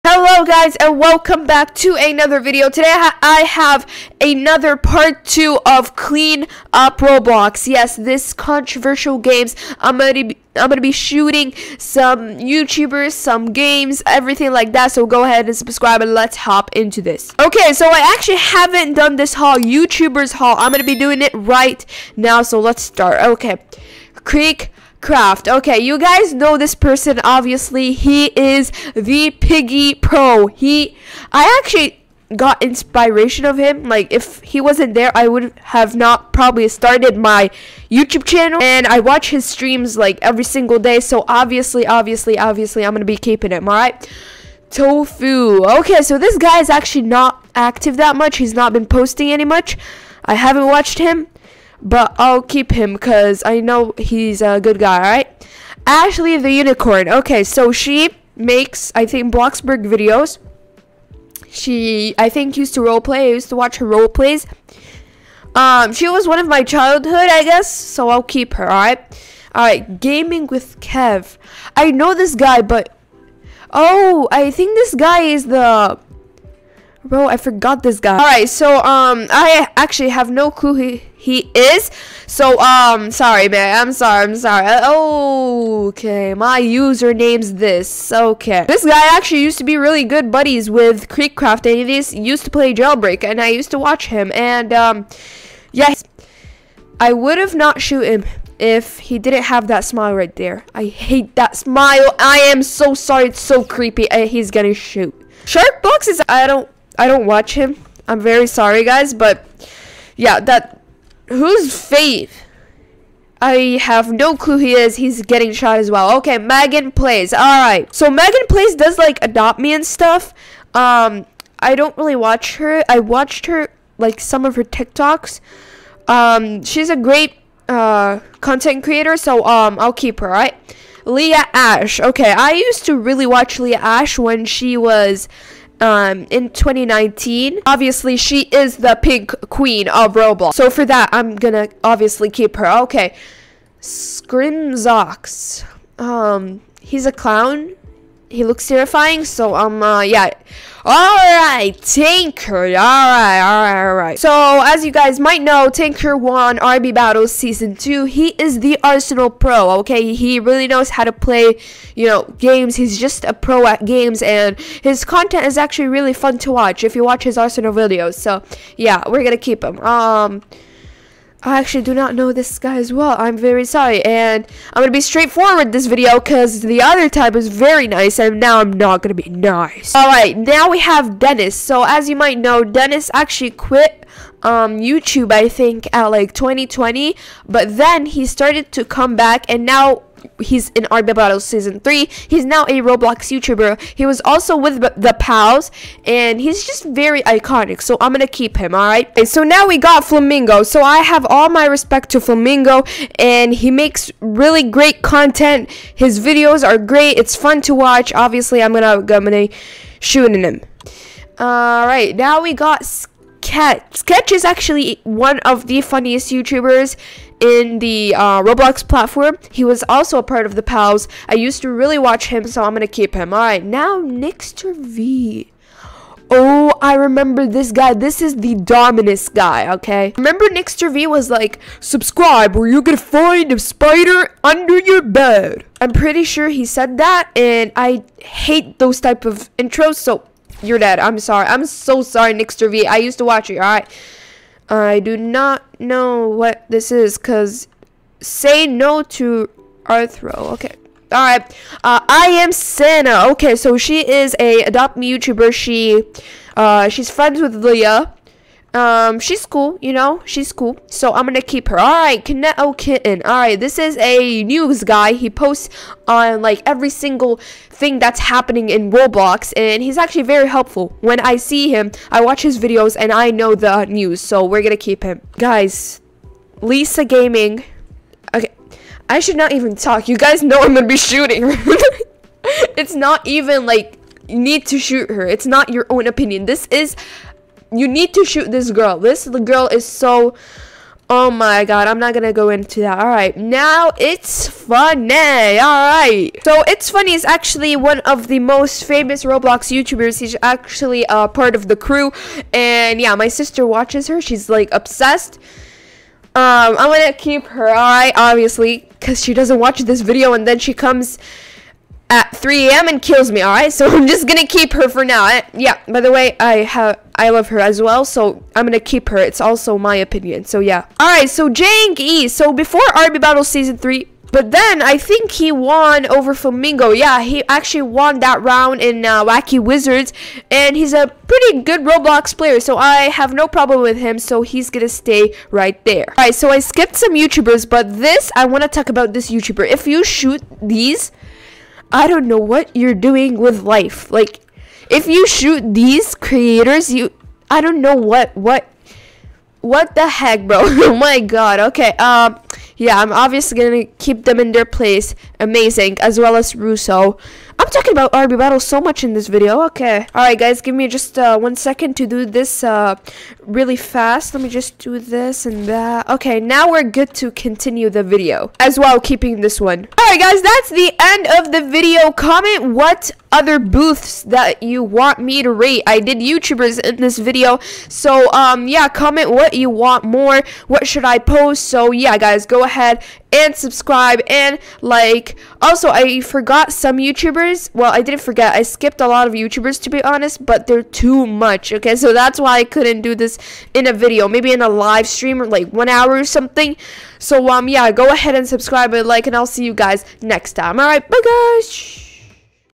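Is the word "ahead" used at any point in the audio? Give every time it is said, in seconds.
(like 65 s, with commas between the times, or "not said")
15 s, 382 s, 398 s.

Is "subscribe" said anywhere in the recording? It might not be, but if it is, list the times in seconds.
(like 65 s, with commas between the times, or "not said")
15 s, 231 s, 383 s, 398 s.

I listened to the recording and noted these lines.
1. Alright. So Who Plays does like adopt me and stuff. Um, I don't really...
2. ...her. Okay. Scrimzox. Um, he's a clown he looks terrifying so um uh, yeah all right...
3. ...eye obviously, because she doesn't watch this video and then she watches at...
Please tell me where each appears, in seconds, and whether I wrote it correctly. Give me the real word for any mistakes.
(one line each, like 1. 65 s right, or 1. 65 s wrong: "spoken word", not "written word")
1. 117 s wrong: "Megan", not "Who"
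2. 142 s right
3. 307 s wrong: "comes", not "watches".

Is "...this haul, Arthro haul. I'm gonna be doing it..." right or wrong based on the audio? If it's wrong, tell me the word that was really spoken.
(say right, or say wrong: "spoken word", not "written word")
wrong: "YouTubers", not "Arthro".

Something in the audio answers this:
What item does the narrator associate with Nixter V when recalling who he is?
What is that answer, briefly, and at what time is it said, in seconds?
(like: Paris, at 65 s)
Dominus, at 228 s.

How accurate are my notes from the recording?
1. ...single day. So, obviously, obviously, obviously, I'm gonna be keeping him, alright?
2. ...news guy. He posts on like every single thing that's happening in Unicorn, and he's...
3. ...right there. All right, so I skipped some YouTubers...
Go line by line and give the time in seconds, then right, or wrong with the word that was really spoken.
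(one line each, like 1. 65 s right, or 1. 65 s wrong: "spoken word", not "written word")
1. 40 s right
2. 264 s wrong: "Roblox", not "Unicorn"
3. 335 s right.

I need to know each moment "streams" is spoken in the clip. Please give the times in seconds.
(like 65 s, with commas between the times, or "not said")
39 s, 395 s.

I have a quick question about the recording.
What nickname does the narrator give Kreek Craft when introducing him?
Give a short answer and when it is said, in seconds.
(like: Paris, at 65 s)
the Piggy Pro, at 28 s.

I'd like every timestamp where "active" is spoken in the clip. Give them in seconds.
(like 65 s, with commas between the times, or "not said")
47 s.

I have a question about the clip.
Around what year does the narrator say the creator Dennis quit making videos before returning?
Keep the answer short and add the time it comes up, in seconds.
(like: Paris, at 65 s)
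2020, at 186 s.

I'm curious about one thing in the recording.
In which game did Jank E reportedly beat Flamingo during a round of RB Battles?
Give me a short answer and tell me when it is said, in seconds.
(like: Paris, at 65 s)
Wacky Wizards, at 329 s.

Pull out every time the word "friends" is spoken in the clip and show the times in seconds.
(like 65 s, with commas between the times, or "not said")
257 s.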